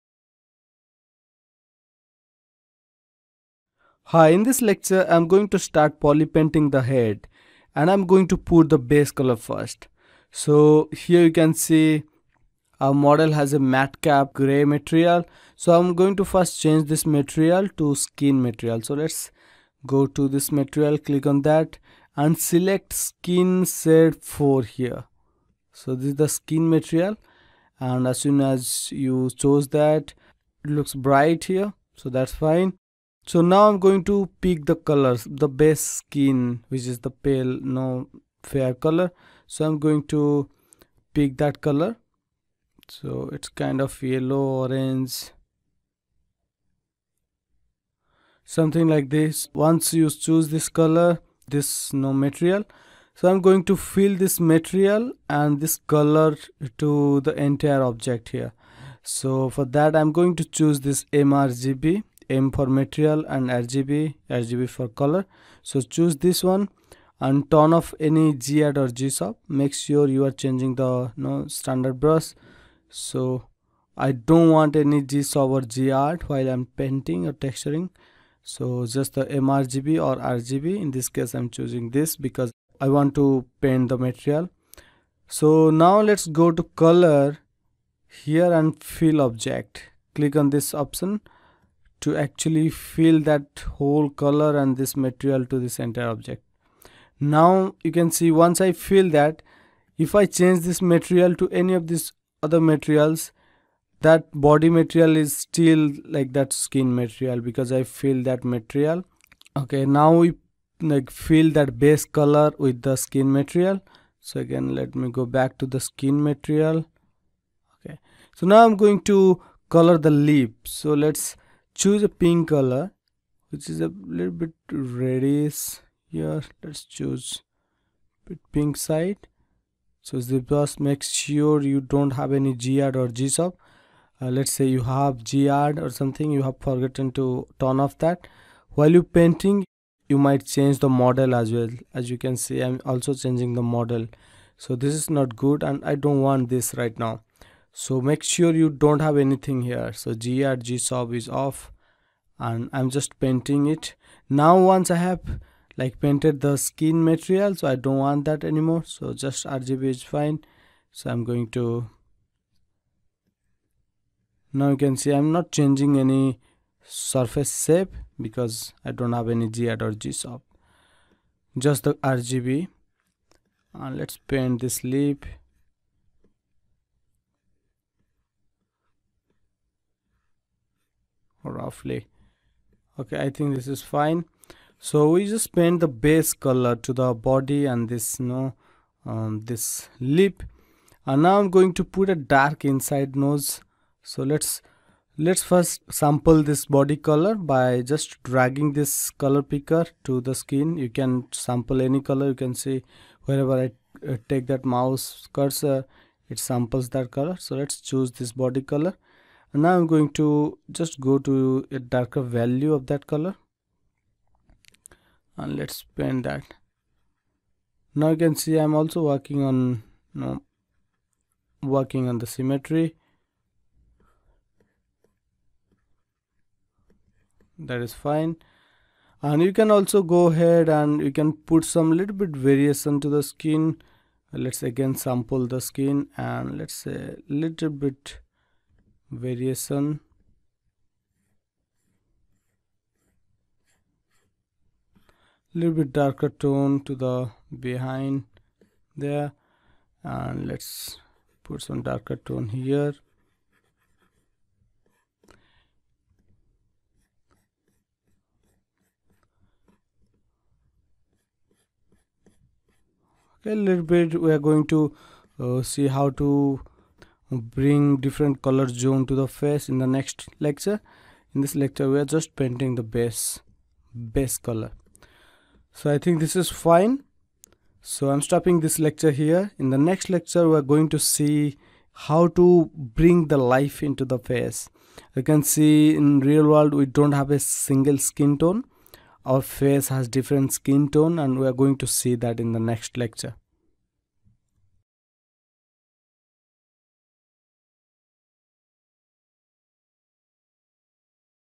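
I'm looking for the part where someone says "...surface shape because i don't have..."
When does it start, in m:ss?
2:46.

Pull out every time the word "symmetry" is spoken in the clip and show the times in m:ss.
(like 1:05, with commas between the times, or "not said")
3:42.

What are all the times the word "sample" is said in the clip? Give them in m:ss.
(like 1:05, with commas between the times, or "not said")
3:15, 3:21, 3:26, 3:54.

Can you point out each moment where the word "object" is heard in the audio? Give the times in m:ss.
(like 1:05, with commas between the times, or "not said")
0:57, 1:29, 1:36.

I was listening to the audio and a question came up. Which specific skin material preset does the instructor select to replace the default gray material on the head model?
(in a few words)
Skin set 4.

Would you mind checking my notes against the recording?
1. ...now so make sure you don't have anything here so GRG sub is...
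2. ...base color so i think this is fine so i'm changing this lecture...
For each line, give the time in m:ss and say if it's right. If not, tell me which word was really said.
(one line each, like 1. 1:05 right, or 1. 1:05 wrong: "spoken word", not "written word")
1. 2:26 right
2. 4:34 wrong: "stopping", not "changing".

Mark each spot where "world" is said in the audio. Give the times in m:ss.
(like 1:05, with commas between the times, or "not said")
4:46.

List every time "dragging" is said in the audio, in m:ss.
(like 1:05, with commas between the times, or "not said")
3:18.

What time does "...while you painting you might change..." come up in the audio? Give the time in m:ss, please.
2:18.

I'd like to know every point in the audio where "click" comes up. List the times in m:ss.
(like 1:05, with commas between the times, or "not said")
0:20, 1:30.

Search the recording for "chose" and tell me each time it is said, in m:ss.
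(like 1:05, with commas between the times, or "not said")
0:29.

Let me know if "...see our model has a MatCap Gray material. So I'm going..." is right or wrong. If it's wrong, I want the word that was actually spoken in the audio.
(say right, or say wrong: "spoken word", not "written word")
right.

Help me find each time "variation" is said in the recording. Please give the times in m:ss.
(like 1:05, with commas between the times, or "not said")
3:52, 3:59.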